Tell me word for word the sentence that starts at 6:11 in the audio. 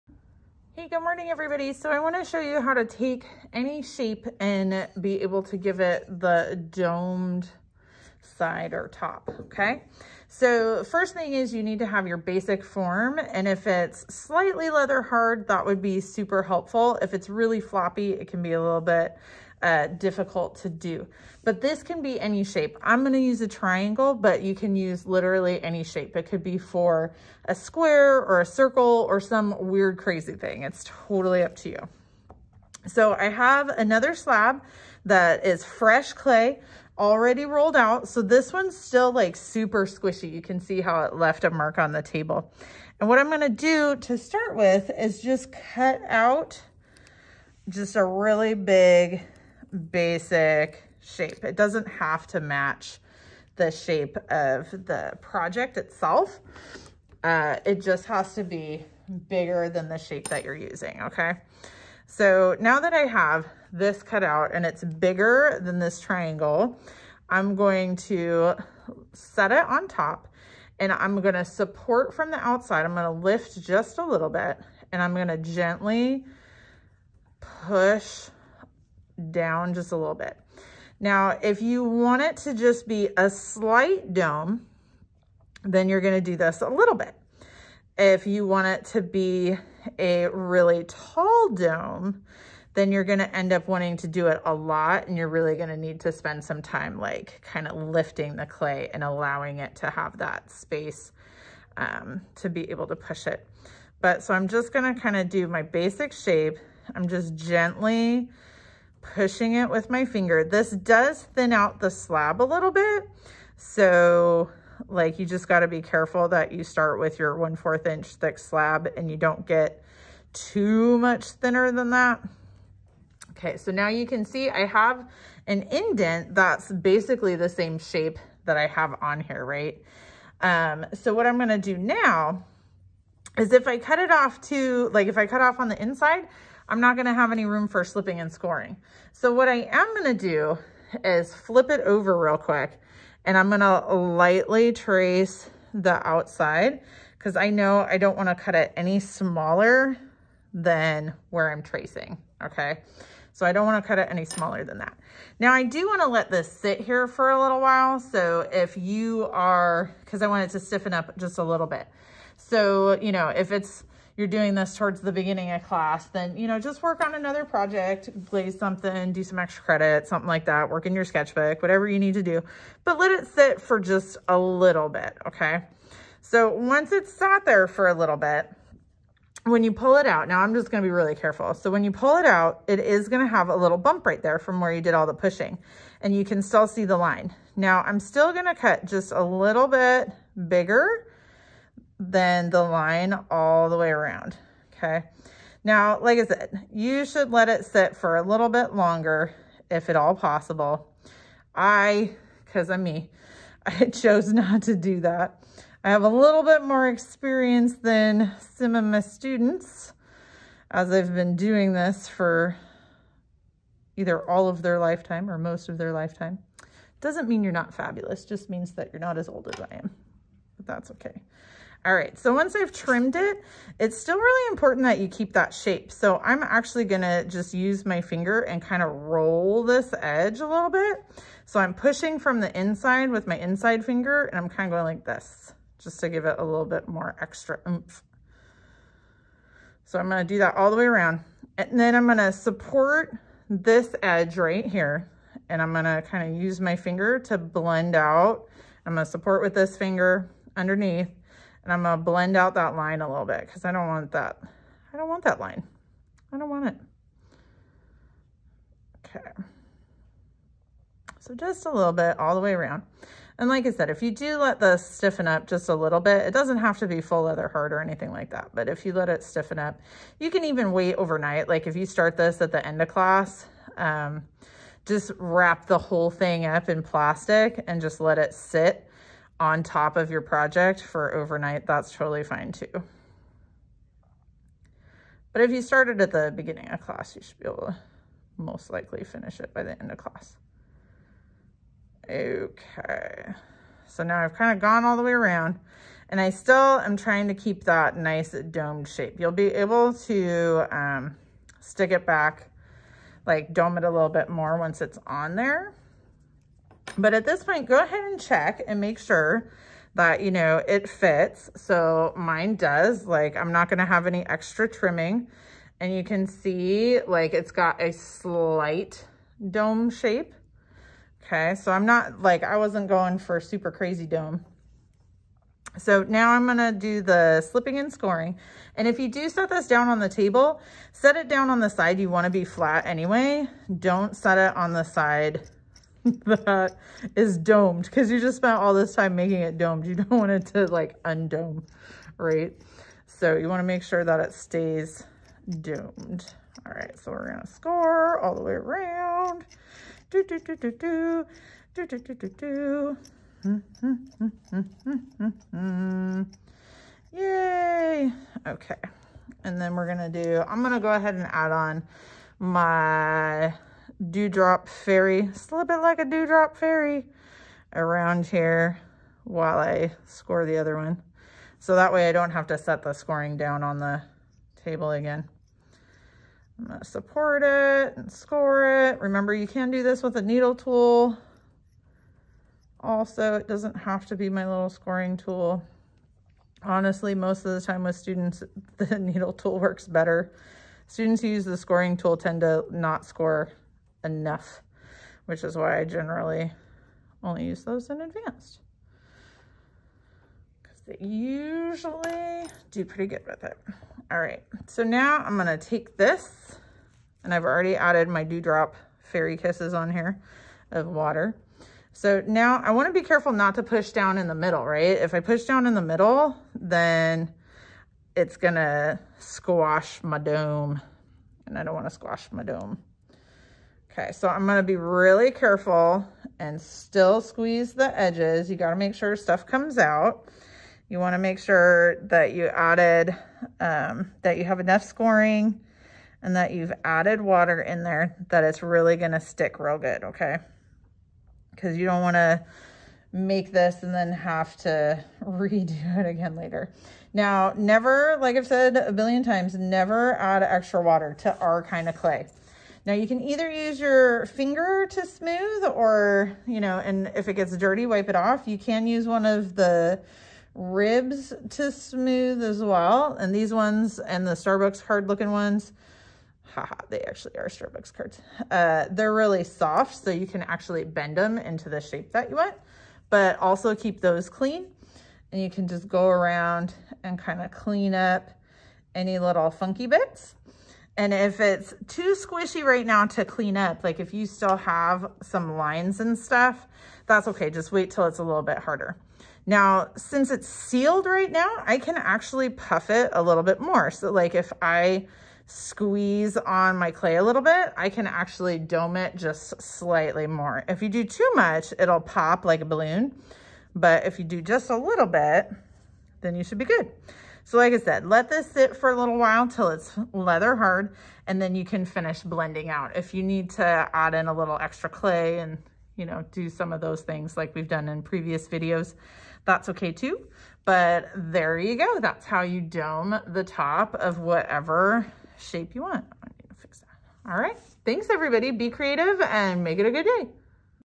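So that way I don't have to set the scoring down on the table again.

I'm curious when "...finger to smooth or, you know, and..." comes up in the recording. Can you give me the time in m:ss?
7:34.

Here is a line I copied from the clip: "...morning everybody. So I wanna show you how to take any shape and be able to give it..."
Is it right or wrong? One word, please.
right.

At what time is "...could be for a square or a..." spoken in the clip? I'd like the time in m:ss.
0:26.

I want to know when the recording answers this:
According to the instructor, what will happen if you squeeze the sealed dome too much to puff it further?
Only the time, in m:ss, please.
8:22.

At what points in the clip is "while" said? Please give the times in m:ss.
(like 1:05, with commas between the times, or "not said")
2:37, 6:09, 8:29.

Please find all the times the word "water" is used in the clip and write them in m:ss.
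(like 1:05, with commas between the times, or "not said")
6:50, 7:17, 7:30.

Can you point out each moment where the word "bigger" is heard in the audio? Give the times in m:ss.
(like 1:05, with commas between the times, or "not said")
0:59, 1:04, 3:10.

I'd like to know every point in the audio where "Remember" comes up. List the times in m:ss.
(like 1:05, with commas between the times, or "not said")
6:18.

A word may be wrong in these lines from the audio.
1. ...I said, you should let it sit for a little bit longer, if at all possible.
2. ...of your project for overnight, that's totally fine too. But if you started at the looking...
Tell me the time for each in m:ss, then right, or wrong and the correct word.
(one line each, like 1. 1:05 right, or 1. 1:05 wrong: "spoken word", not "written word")
1. 3:16 right
2. 4:39 wrong: "beginning", not "looking".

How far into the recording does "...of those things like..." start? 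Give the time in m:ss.
8:36.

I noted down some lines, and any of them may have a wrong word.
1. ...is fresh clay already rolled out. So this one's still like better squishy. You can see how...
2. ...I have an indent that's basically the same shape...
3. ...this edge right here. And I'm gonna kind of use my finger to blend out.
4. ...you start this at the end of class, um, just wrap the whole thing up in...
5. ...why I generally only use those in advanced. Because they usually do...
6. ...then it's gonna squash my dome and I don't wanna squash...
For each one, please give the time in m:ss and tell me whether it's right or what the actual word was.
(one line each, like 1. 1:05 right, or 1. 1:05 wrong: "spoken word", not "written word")
1. 0:35 wrong: "super", not "better"
2. 2:04 right
3. 4:03 right
4. 4:31 right
5. 6:35 right
6. 6:56 right.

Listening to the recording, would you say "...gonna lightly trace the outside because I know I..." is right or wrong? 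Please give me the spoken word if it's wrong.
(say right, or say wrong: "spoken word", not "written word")
right.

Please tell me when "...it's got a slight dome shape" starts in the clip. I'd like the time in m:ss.
5:17.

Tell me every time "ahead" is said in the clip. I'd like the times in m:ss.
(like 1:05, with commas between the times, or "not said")
5:07, 6:00.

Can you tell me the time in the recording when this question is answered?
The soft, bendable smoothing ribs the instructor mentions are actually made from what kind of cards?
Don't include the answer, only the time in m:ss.
7:47.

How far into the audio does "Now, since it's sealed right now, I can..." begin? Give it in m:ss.
8:09.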